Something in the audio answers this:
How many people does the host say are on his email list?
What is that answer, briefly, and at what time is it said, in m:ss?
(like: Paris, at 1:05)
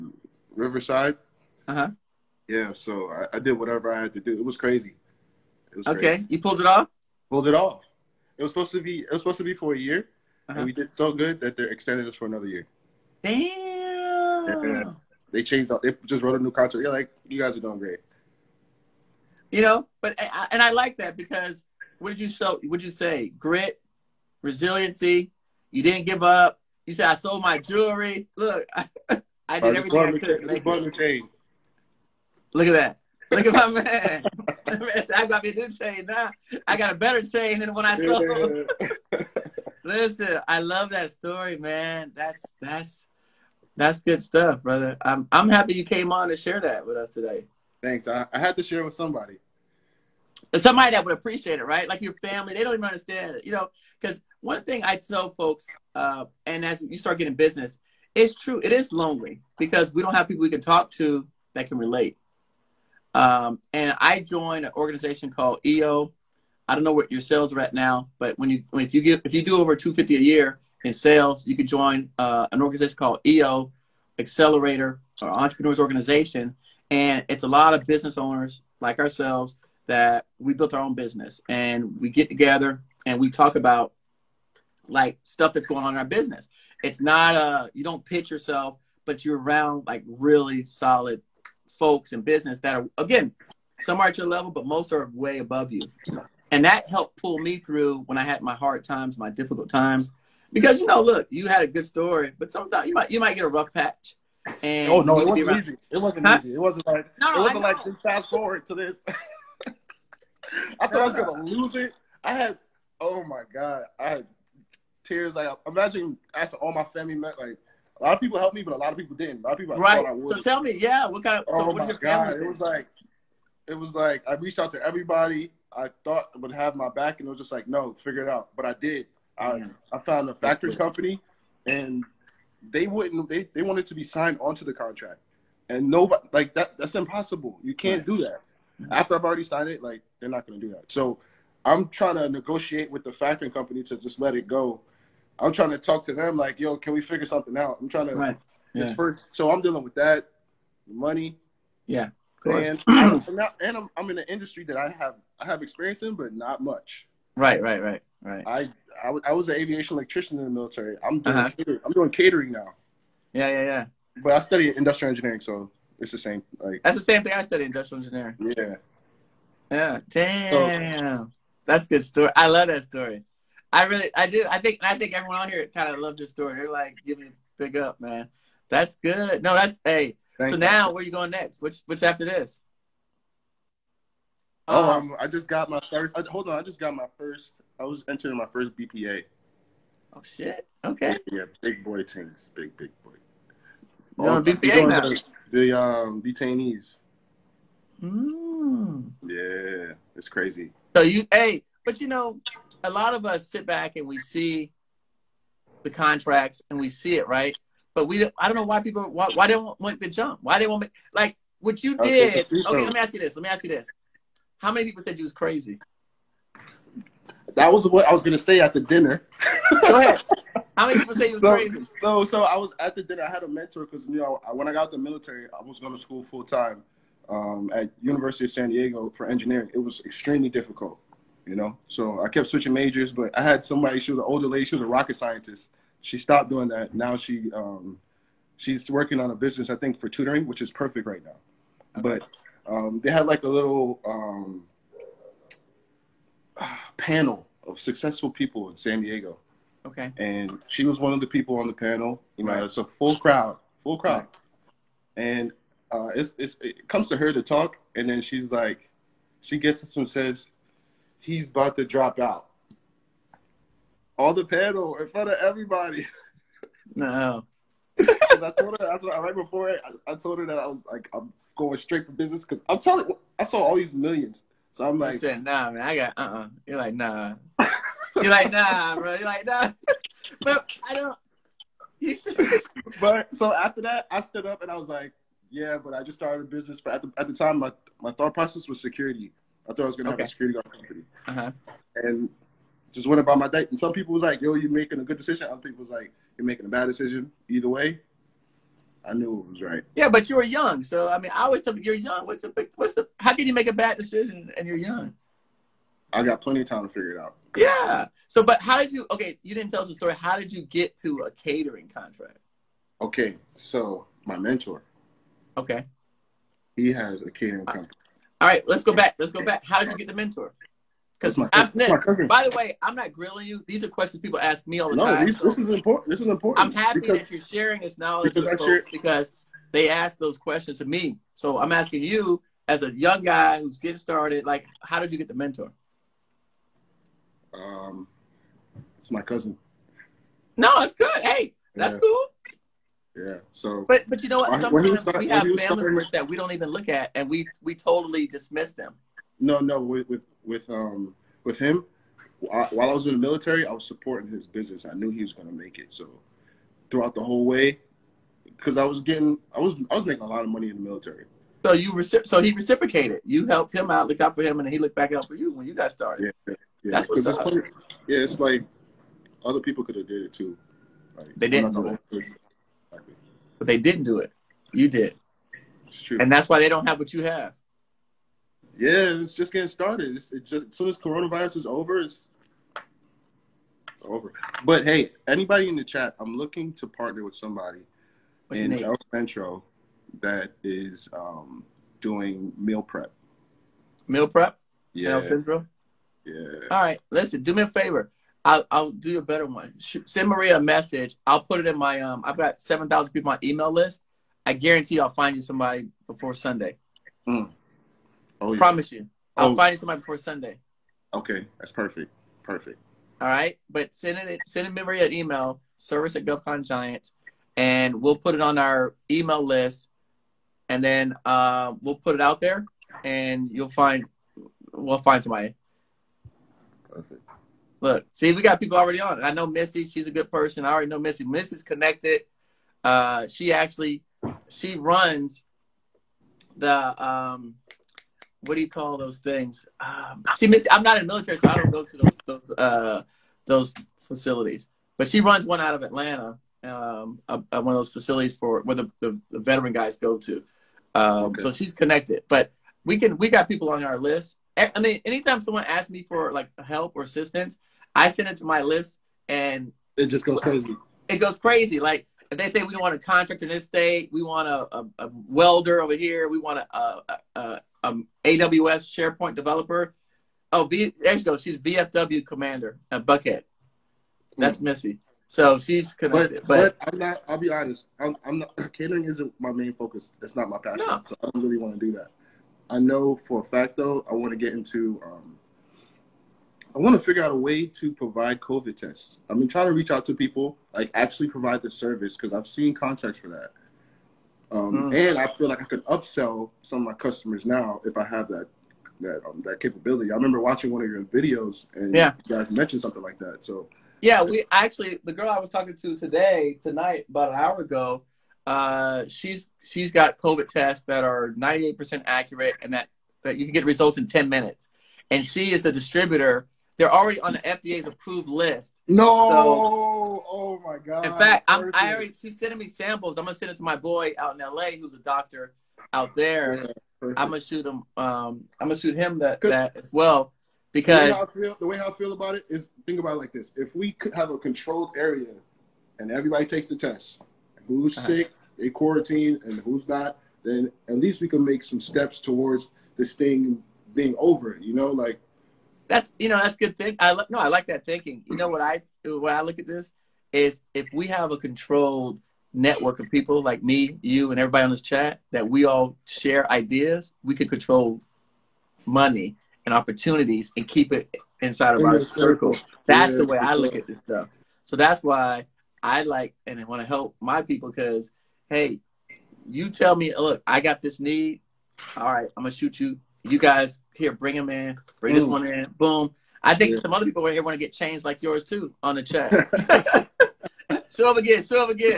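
7,000, at 6:42.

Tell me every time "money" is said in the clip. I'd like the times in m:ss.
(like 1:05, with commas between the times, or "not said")
2:30, 6:00, 9:18.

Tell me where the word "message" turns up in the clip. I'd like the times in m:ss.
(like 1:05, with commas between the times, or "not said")
6:40.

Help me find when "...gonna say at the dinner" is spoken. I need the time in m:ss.
3:38.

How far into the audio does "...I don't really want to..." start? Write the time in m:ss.
8:01.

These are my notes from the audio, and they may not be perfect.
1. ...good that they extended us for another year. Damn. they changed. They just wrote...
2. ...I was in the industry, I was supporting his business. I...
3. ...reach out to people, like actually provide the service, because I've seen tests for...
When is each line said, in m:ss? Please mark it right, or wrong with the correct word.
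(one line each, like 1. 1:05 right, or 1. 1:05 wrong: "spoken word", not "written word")
1. 0:11 right
2. 5:52 wrong: "military", not "industry"
3. 8:09 wrong: "contracts", not "tests".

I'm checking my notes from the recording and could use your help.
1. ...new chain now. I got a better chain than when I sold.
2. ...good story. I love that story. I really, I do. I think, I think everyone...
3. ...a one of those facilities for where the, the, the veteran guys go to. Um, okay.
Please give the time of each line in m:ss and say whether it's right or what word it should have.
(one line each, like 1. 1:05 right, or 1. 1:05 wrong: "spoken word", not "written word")
1. 0:35 right
2. 2:51 right
3. 7:27 right.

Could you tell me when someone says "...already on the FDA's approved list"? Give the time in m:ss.
8:36.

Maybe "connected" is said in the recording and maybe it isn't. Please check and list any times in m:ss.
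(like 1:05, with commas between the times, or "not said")
7:11, 7:31, 7:55.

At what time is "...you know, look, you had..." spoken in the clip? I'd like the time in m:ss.
1:40.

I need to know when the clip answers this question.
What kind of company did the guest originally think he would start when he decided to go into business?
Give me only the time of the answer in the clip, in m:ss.
4:50.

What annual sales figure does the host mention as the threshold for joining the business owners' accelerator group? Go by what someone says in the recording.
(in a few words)
250.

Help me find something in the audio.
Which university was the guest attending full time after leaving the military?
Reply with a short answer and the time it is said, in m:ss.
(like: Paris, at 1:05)
University of San Diego, at 3:48.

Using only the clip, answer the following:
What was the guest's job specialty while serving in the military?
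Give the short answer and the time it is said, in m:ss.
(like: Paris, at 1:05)
aviation electrician, at 2:39.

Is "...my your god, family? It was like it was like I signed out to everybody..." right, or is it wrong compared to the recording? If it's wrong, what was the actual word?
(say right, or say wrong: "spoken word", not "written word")
wrong: "reached", not "signed".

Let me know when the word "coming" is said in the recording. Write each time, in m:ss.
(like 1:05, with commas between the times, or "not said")
not said.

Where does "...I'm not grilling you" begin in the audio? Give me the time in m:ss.
5:22.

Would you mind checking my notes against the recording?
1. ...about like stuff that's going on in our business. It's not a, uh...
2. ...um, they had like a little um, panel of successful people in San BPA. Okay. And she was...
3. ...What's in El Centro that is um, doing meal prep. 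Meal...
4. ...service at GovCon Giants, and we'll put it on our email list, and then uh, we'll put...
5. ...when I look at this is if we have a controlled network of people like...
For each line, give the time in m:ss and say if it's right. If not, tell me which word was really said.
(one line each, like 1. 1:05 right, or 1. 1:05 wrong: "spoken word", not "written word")
1. 1:23 right
2. 4:02 wrong: "Diego", not "BPA"
3. 6:28 right
4. 6:55 right
5. 9:09 right.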